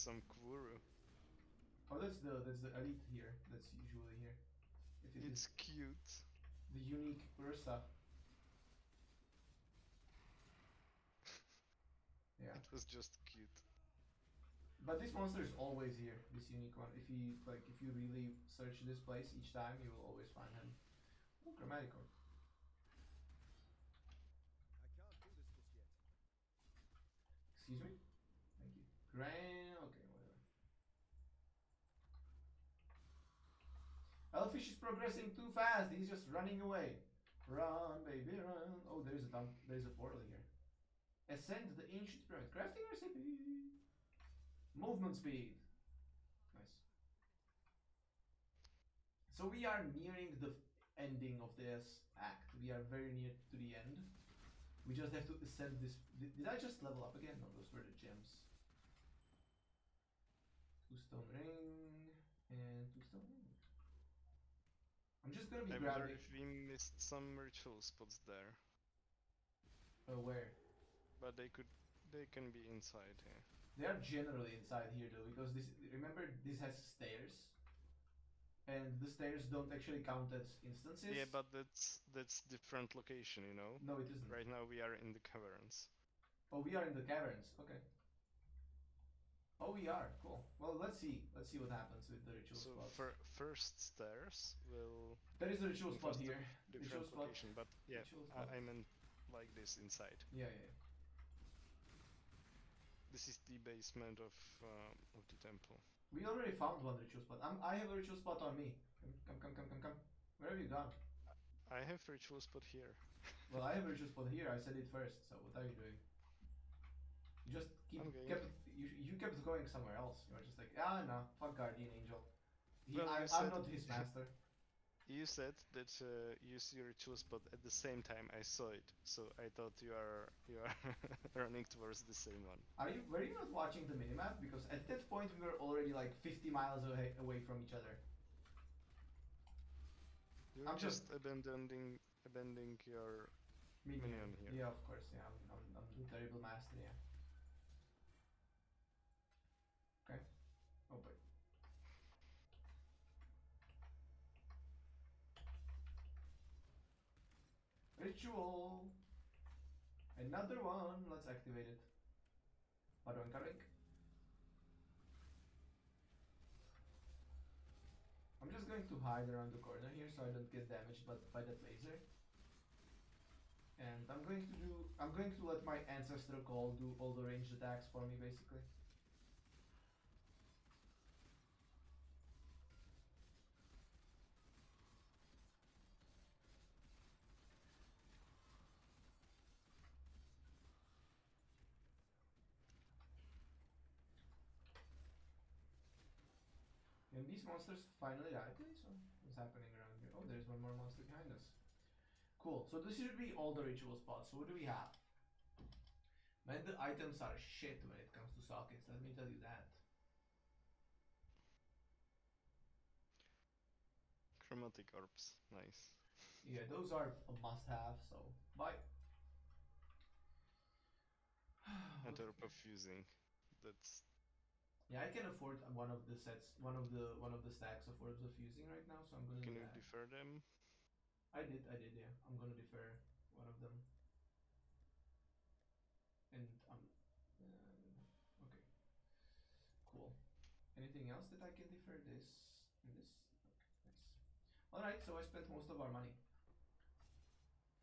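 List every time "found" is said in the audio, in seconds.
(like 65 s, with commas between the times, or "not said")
106 s.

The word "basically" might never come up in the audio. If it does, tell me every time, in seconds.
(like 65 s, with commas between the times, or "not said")
178 s.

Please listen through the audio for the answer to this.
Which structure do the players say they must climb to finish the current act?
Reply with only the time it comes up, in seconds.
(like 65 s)
41 s.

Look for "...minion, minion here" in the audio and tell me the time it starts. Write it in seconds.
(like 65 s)
143 s.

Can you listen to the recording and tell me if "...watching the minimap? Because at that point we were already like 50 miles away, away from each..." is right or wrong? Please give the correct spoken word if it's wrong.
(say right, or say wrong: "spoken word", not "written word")
right.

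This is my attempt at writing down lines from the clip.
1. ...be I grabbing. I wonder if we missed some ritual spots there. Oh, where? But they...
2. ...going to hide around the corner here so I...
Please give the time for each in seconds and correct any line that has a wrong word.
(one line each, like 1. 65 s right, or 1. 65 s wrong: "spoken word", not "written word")
1. 65 s right
2. 168 s right.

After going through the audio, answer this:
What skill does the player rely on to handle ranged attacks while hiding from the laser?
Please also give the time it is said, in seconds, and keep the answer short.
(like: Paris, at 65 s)
ancestor call, at 175 s.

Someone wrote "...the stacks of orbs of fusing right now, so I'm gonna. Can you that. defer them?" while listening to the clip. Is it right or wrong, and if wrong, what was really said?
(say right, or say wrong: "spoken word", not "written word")
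right.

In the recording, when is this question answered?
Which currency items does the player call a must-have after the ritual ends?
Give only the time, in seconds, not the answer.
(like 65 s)
214 s.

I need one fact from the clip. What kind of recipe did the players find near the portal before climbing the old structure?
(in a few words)
Movement speed.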